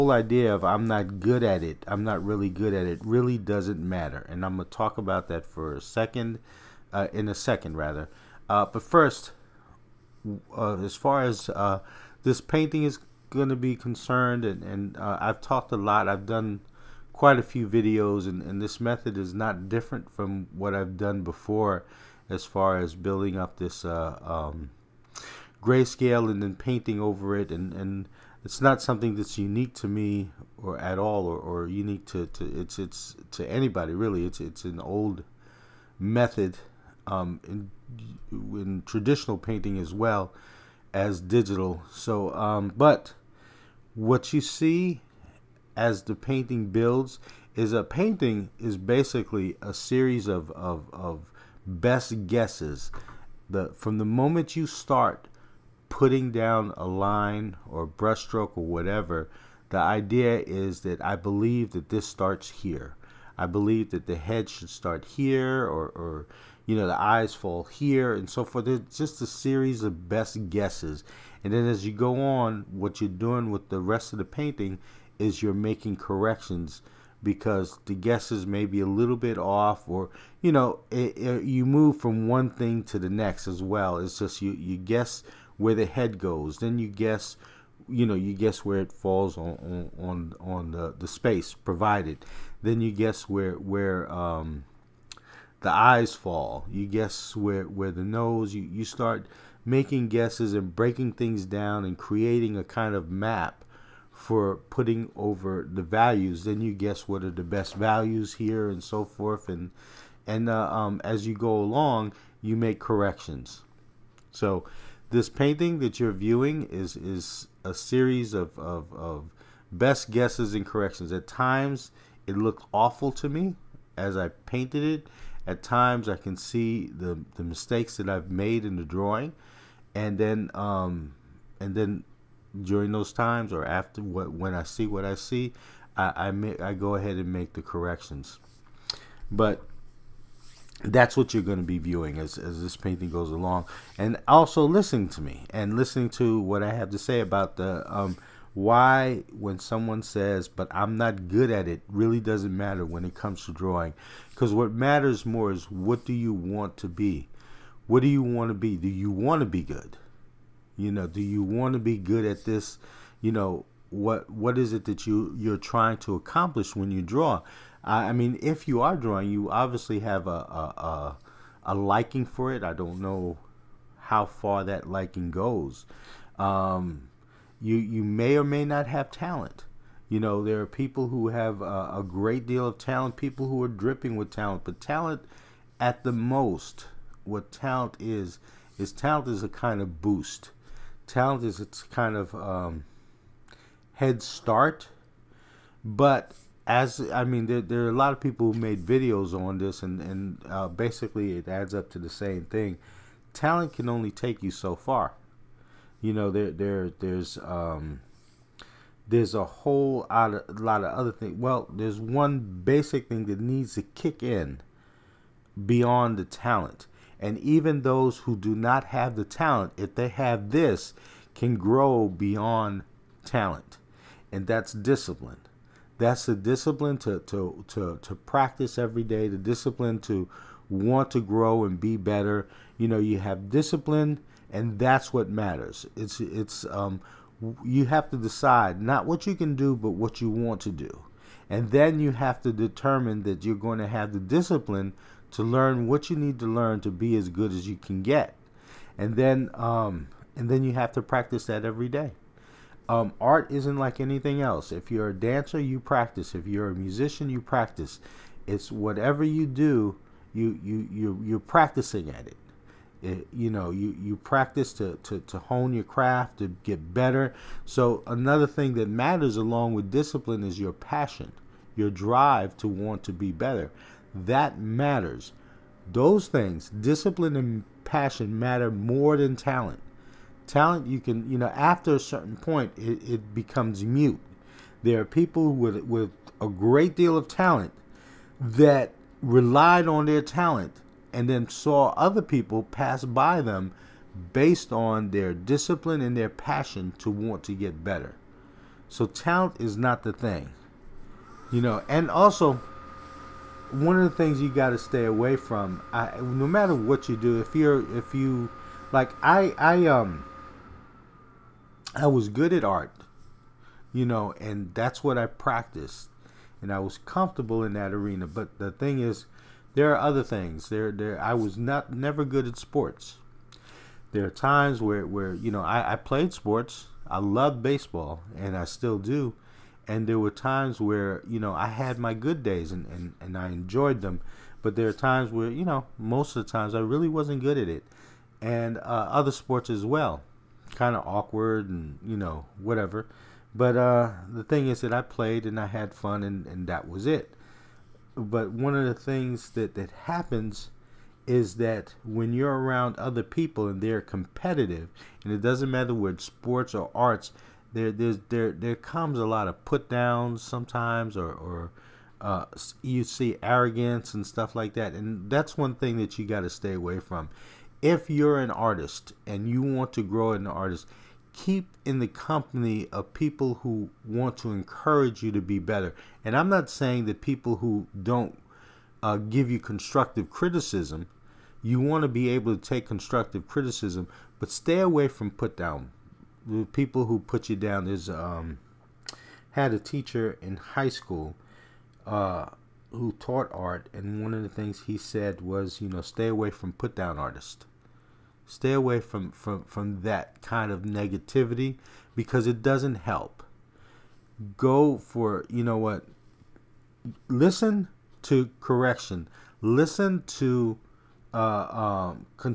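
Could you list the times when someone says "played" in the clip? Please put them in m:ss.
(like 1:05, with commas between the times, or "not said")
5:25, 5:45.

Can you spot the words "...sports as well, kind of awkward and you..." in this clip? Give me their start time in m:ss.
5:39.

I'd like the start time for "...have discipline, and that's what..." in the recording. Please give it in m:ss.
3:53.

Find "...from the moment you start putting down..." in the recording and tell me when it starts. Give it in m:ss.
0:53.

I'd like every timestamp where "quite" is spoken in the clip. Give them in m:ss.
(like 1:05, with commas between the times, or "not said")
0:17.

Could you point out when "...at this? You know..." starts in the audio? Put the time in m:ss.
2:42.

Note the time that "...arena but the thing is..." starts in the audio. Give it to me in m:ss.
5:17.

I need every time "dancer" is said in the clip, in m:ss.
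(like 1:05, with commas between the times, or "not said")
4:15.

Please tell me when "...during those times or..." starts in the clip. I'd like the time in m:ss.
2:12.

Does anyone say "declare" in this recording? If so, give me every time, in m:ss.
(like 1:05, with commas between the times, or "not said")
not said.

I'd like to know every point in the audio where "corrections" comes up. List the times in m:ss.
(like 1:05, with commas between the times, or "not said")
1:15, 1:52, 2:00, 2:17, 6:48.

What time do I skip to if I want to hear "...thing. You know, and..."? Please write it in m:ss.
5:00.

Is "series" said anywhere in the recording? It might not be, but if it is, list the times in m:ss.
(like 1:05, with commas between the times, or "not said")
0:49, 1:09, 1:57.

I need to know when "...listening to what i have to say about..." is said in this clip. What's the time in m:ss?
2:25.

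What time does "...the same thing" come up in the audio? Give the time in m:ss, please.
3:21.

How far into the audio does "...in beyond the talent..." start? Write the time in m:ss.
3:34.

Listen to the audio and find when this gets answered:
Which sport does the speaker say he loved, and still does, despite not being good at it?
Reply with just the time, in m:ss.
5:27.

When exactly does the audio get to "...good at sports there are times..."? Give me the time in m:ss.
5:22.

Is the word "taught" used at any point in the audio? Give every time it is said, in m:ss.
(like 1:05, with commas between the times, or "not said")
6:33.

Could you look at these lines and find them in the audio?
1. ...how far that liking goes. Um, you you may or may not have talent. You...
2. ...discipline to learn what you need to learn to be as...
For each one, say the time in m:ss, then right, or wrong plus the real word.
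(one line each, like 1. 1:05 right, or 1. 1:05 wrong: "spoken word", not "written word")
1. 2:53 right
2. 4:04 right.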